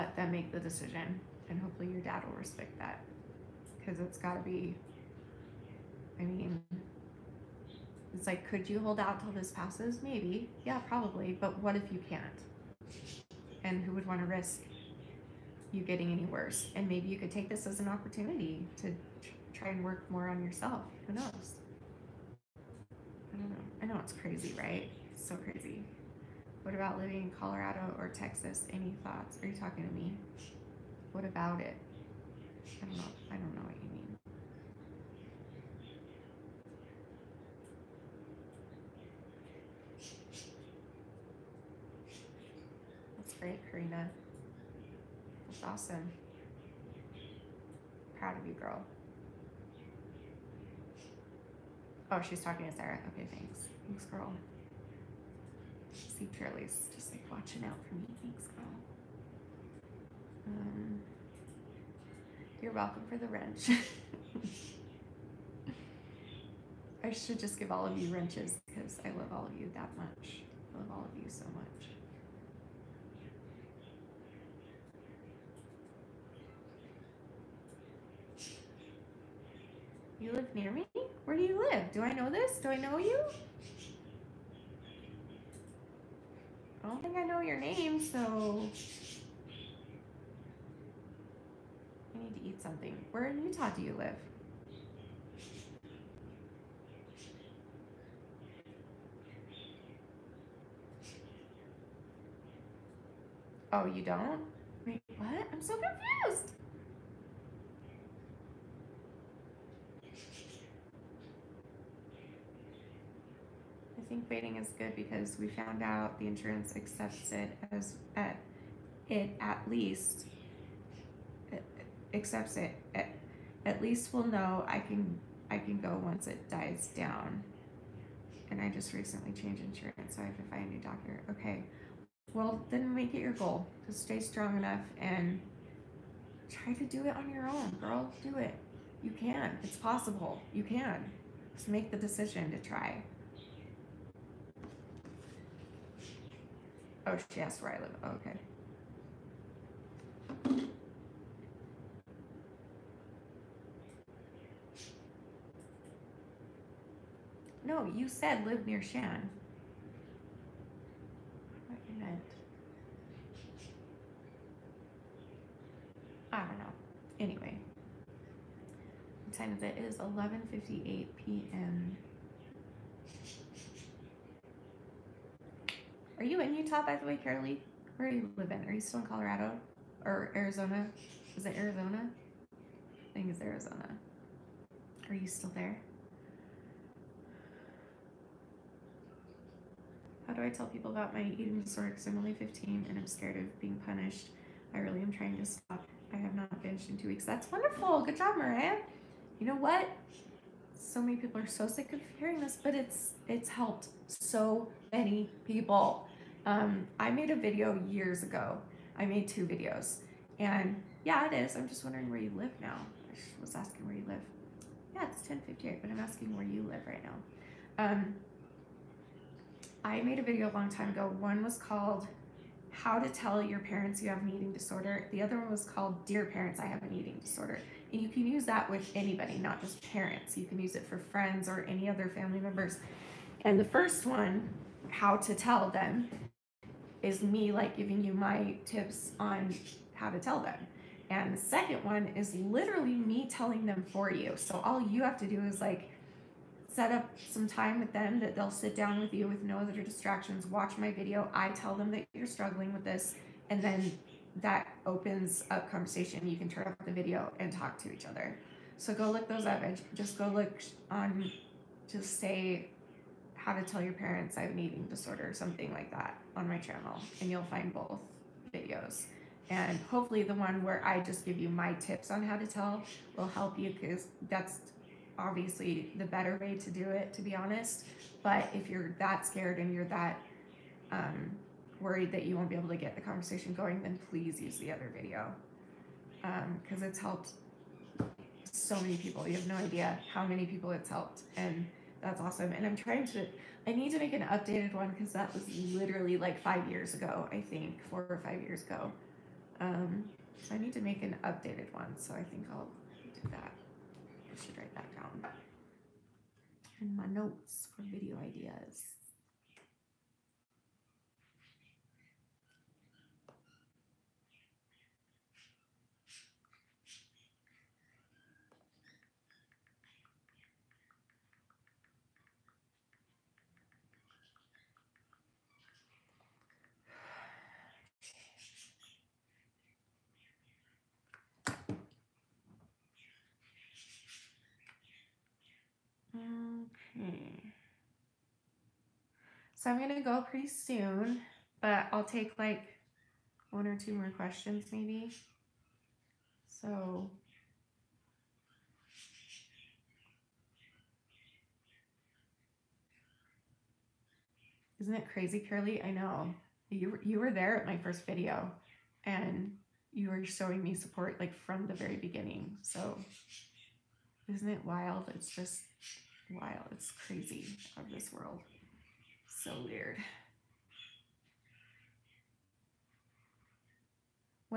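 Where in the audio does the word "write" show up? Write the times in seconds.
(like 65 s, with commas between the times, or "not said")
304 s.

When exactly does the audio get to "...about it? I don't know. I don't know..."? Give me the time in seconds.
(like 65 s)
31 s.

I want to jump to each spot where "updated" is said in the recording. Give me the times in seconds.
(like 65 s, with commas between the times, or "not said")
294 s, 301 s.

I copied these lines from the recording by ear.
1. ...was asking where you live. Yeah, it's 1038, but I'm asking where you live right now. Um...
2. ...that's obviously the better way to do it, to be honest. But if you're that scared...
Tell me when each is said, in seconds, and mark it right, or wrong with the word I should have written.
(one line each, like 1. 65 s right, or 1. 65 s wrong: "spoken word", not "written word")
1. 213 s wrong: "1058", not "1038"
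2. 274 s right.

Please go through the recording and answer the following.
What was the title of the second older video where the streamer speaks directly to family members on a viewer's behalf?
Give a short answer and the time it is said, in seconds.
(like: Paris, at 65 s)
Dear Parents, I Have an Eating Disorder, at 226 s.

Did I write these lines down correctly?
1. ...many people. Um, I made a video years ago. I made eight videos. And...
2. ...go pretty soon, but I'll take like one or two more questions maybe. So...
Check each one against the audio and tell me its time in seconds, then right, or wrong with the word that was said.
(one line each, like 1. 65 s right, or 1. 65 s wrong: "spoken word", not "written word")
1. 204 s wrong: "two", not "eight"
2. 340 s right.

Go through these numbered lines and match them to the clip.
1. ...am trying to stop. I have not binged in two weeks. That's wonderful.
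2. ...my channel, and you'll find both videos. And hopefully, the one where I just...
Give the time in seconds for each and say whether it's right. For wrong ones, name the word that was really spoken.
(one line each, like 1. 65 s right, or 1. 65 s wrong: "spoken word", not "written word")
1. 195 s right
2. 266 s right.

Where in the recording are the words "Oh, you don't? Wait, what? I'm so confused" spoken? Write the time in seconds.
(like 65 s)
103 s.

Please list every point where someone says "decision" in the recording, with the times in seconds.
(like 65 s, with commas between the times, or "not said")
0 s, 141 s.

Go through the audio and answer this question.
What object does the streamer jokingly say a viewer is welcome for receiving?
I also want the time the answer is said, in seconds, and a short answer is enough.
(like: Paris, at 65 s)
wrench, at 63 s.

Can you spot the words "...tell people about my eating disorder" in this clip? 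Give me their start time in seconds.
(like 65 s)
190 s.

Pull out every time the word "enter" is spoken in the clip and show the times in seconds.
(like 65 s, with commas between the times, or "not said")
not said.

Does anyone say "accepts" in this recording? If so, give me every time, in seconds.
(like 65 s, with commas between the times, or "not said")
116 s, 122 s.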